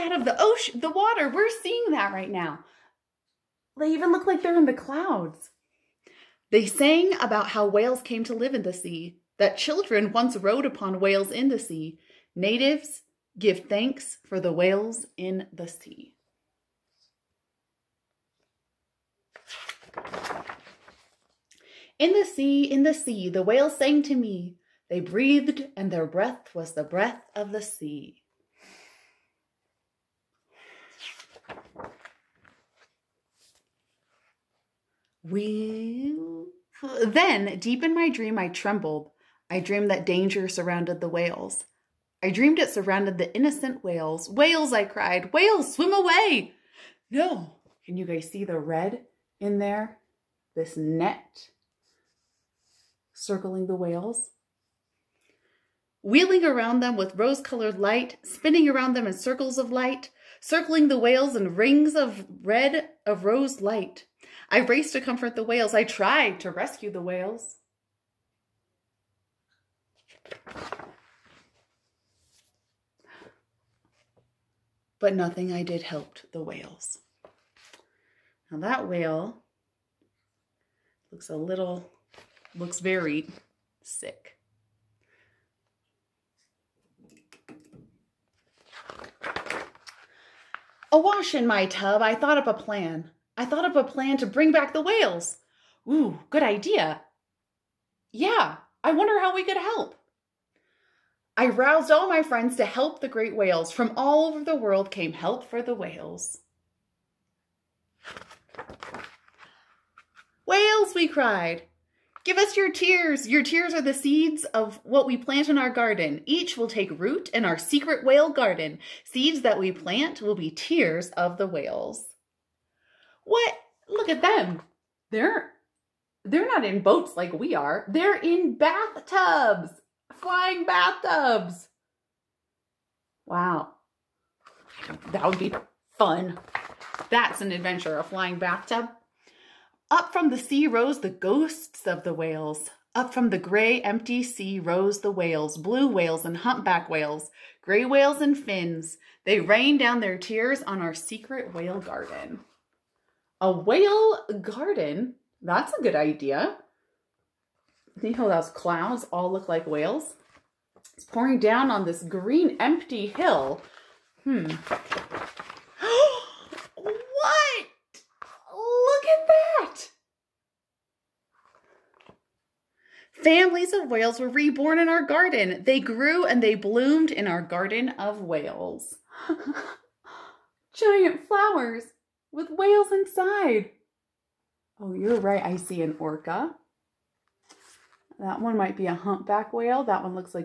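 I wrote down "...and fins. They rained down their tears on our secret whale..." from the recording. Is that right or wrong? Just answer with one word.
right.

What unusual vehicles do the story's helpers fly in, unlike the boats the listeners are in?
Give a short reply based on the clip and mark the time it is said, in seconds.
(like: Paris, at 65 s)
Flying bathtubs, at 130 s.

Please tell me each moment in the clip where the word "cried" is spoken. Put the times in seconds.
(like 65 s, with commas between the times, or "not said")
44 s, 111 s.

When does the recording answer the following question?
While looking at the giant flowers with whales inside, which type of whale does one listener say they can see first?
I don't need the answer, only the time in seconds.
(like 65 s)
185 s.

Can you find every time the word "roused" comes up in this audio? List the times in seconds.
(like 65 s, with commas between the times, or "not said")
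101 s.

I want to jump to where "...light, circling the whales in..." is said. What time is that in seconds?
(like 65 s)
59 s.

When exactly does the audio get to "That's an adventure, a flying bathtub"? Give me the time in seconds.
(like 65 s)
137 s.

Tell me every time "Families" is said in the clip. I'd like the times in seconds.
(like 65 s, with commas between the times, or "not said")
173 s.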